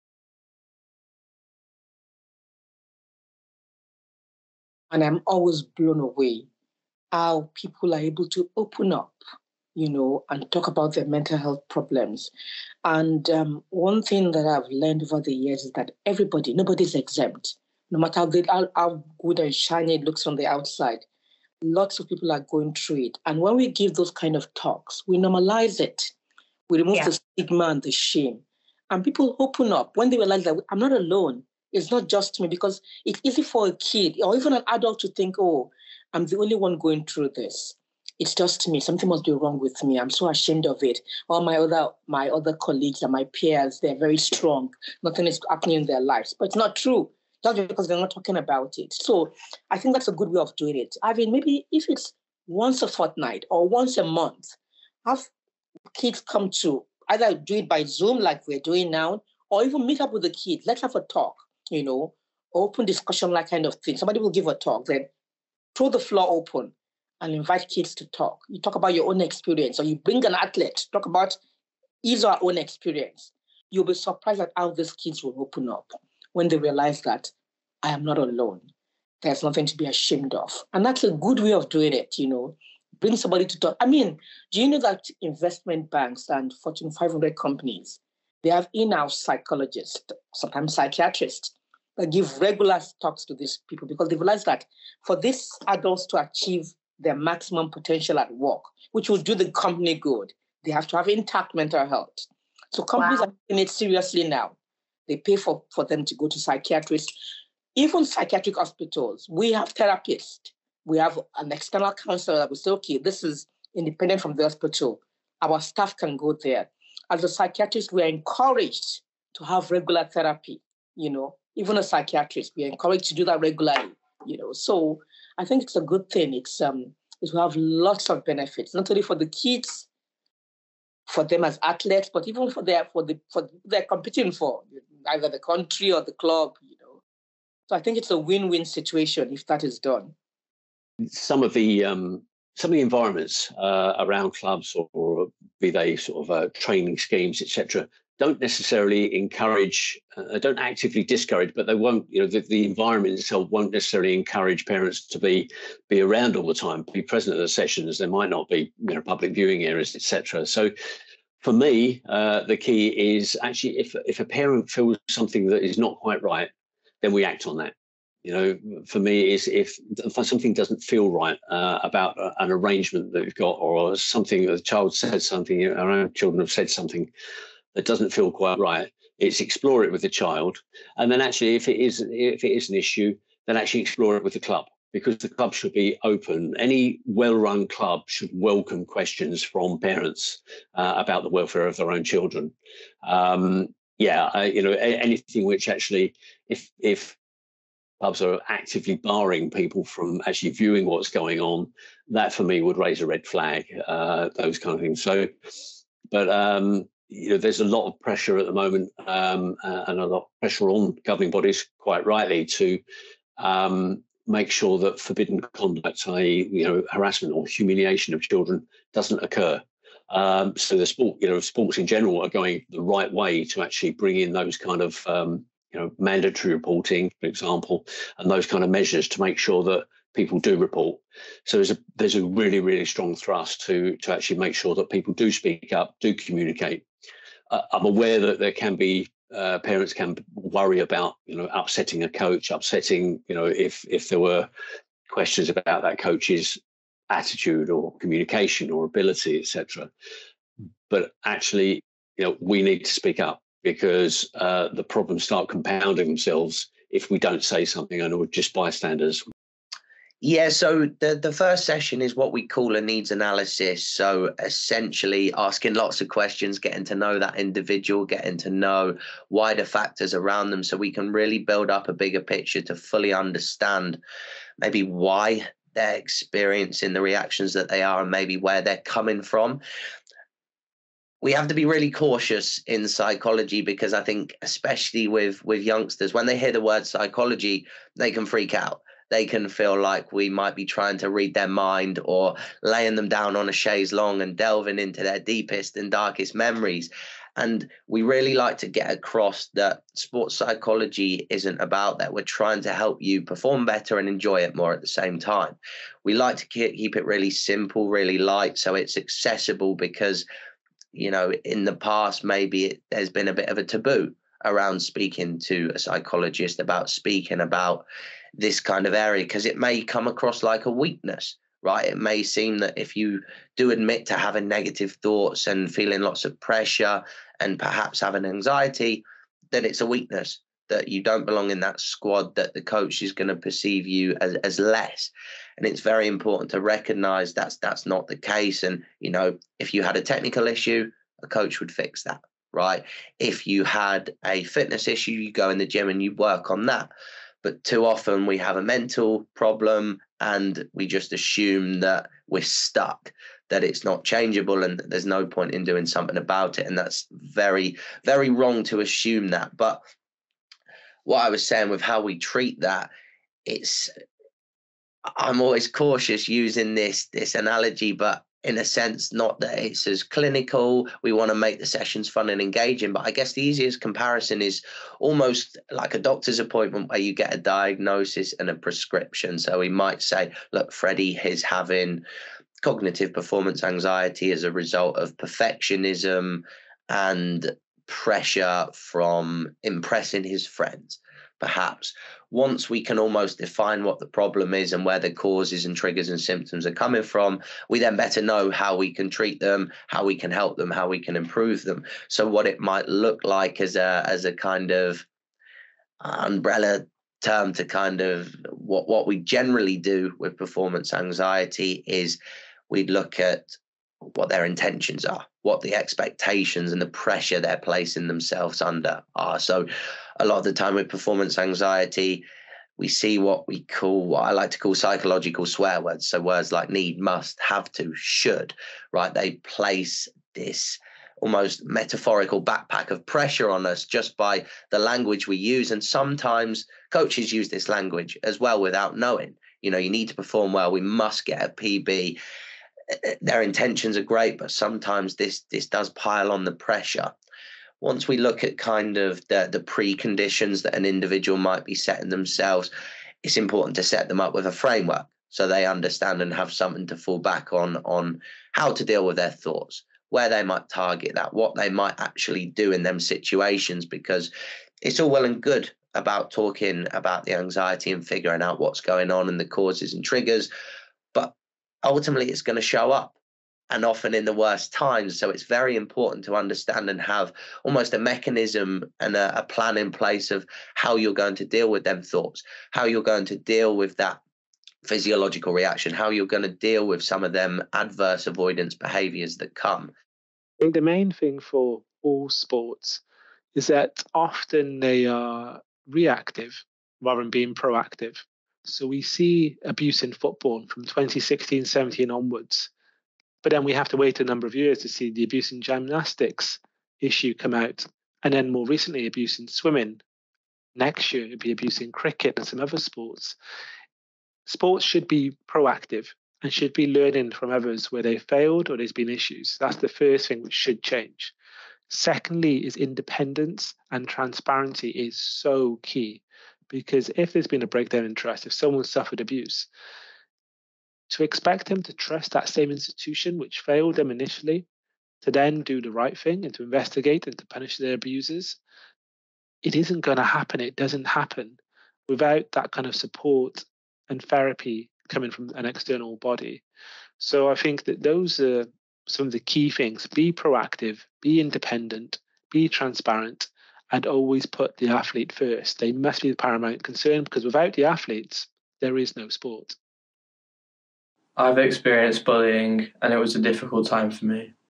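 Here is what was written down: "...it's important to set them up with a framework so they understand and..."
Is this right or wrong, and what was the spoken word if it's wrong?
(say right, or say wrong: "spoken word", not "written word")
right.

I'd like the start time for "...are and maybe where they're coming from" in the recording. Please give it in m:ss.
4:37.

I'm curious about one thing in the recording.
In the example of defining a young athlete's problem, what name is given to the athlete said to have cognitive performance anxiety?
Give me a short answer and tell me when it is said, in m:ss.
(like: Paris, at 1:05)
Freddie, at 6:20.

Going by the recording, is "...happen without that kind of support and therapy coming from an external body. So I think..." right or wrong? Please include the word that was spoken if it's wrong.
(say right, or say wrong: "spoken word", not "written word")
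right.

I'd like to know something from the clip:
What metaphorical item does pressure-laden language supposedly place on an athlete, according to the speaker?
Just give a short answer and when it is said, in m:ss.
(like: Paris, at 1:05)
backpack, at 7:12.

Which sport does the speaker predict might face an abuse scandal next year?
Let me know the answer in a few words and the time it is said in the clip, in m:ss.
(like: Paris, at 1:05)
cricket, at 8:31.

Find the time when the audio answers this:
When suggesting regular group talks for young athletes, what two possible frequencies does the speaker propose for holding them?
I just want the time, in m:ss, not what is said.
0:52.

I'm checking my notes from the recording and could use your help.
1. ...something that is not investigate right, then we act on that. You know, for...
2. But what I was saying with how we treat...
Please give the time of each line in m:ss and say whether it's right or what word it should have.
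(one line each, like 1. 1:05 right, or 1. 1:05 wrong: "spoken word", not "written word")
1. 2:45 wrong: "quite", not "investigate"
2. 5:59 right.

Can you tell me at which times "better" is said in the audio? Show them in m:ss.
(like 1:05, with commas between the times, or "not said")
5:03, 6:37.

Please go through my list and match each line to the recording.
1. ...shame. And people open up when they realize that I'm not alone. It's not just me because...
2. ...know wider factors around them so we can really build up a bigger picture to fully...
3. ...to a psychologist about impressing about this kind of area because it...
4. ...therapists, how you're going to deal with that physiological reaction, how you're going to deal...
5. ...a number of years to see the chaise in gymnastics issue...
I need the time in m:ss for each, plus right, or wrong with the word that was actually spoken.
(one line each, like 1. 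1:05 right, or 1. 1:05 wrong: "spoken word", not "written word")
1. 0:27 right
2. 4:28 right
3. 5:15 wrong: "speaking", not "impressing"
4. 8:02 wrong: "thoughts", not "therapists"
5. 8:24 wrong: "abuse", not "chaise".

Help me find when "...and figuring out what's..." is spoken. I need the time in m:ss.
7:47.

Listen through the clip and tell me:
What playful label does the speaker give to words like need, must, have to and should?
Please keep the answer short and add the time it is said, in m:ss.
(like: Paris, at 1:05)
psychological swear words, at 7:04.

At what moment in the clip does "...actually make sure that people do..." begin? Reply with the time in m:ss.
3:54.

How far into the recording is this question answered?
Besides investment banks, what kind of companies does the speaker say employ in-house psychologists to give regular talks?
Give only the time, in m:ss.
1:26.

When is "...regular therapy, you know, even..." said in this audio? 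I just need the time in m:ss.
1:59.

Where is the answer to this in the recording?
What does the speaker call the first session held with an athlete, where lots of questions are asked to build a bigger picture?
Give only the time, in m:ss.
4:22.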